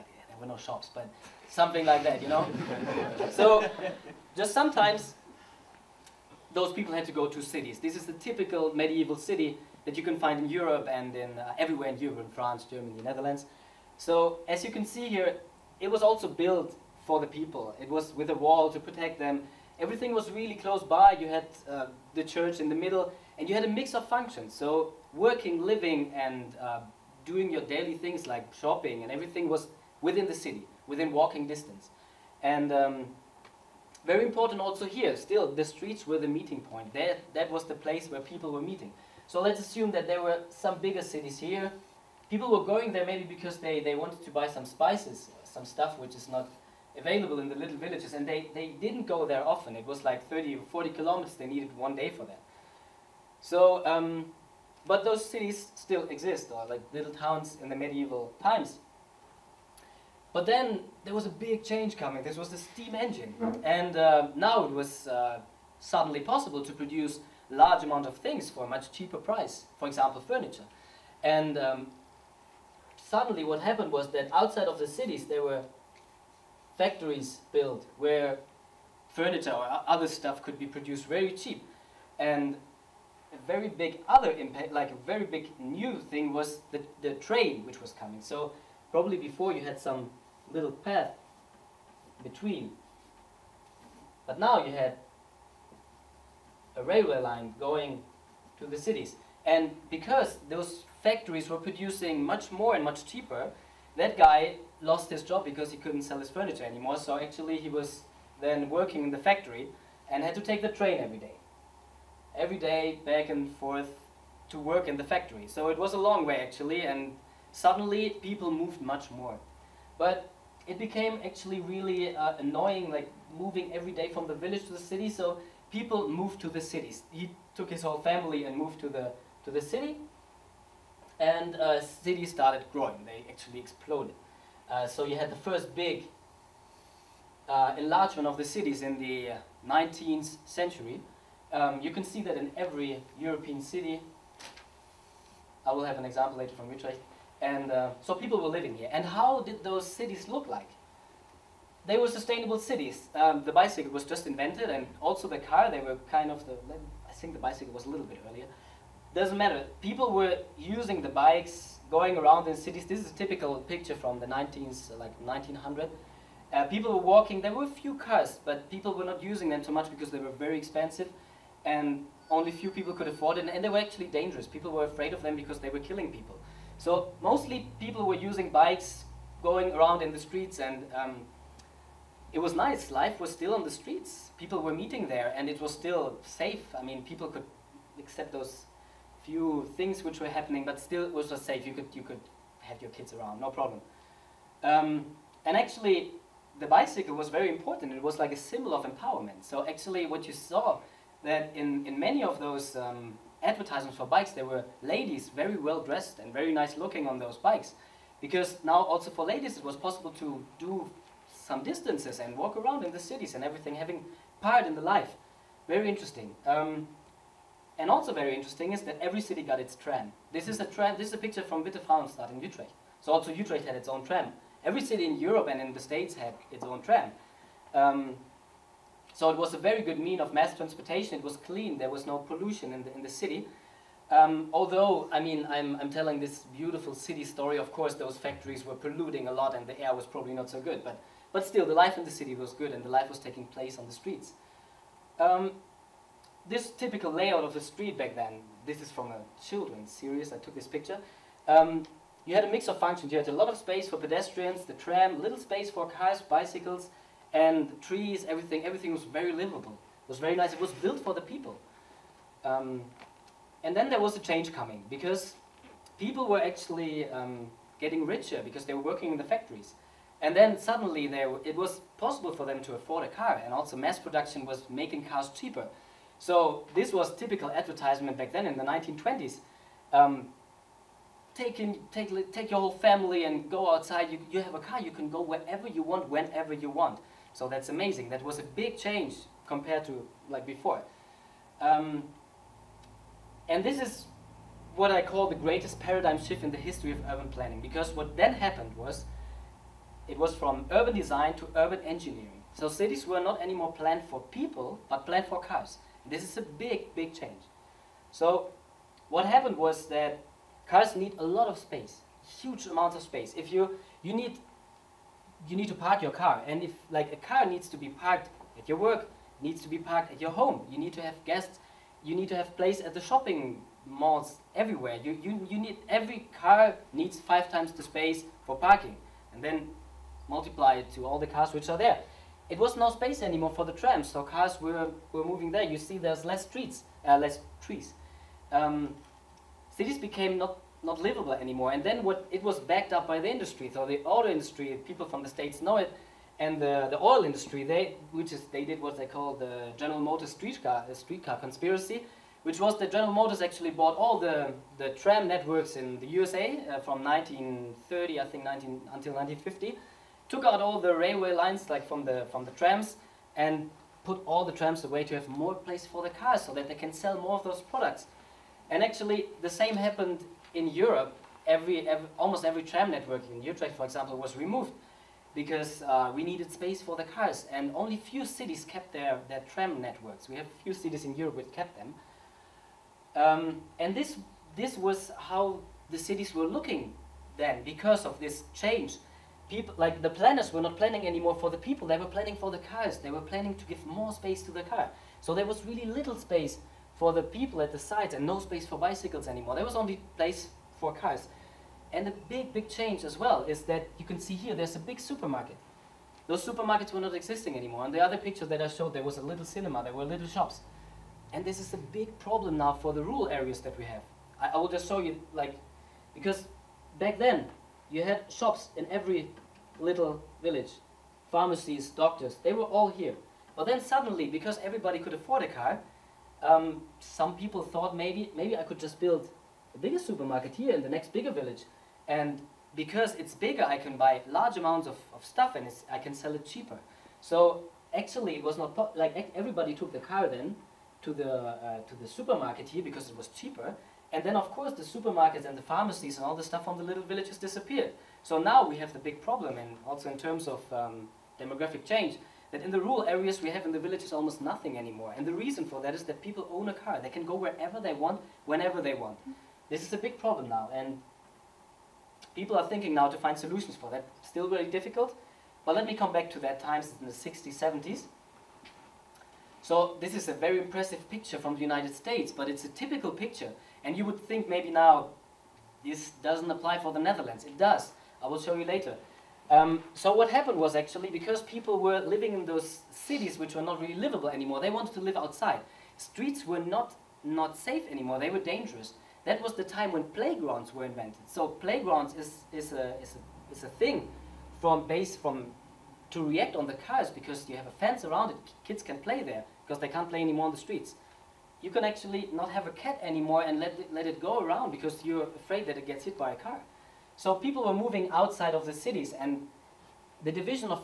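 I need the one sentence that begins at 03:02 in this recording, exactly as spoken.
Life was still on the streets.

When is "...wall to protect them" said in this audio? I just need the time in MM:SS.
00:18.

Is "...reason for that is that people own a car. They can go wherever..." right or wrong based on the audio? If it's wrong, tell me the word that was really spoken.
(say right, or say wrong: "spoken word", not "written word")
right.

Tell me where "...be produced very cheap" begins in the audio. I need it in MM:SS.
01:20.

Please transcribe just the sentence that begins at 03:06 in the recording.
I mean, people could accept those few things which were happening, but still it was just safe.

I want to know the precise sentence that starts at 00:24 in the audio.
So working, living, and uh, doing your daily things like shopping and everything was within the city, within walking distance.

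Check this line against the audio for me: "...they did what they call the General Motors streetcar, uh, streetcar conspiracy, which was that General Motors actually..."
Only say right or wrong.
right.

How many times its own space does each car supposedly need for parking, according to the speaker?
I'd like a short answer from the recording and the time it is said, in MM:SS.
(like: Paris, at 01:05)
5, at 05:27.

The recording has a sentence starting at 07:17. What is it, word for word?
So actually, it was not, like everybody took the car then to the, uh, to the supermarket here because it was cheaper.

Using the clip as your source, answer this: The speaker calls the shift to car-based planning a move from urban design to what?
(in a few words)
Urban engineering.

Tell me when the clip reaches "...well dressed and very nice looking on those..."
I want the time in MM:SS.
03:25.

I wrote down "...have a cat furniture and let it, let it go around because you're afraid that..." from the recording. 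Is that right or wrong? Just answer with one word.
wrong.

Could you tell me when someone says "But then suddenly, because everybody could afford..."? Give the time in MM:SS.
07:03.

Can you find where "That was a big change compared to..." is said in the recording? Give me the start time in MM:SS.
04:48.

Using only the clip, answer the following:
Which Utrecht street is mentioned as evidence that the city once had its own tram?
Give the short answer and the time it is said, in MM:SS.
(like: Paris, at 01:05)
Wittevrouwenstraat, at 03:41.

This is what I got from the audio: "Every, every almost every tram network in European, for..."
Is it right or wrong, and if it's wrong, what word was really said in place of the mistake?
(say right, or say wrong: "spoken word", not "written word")
wrong: "Utrecht", not "European".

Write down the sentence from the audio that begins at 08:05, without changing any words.
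Streets were not, not safe anymore, they were dangerous.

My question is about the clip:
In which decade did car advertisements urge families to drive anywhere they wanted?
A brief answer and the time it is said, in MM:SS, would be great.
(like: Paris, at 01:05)
1920s, at 04:38.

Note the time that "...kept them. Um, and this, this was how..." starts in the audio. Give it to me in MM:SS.
06:21.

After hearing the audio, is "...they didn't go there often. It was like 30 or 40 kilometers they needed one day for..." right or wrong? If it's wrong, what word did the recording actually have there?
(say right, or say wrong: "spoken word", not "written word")
right.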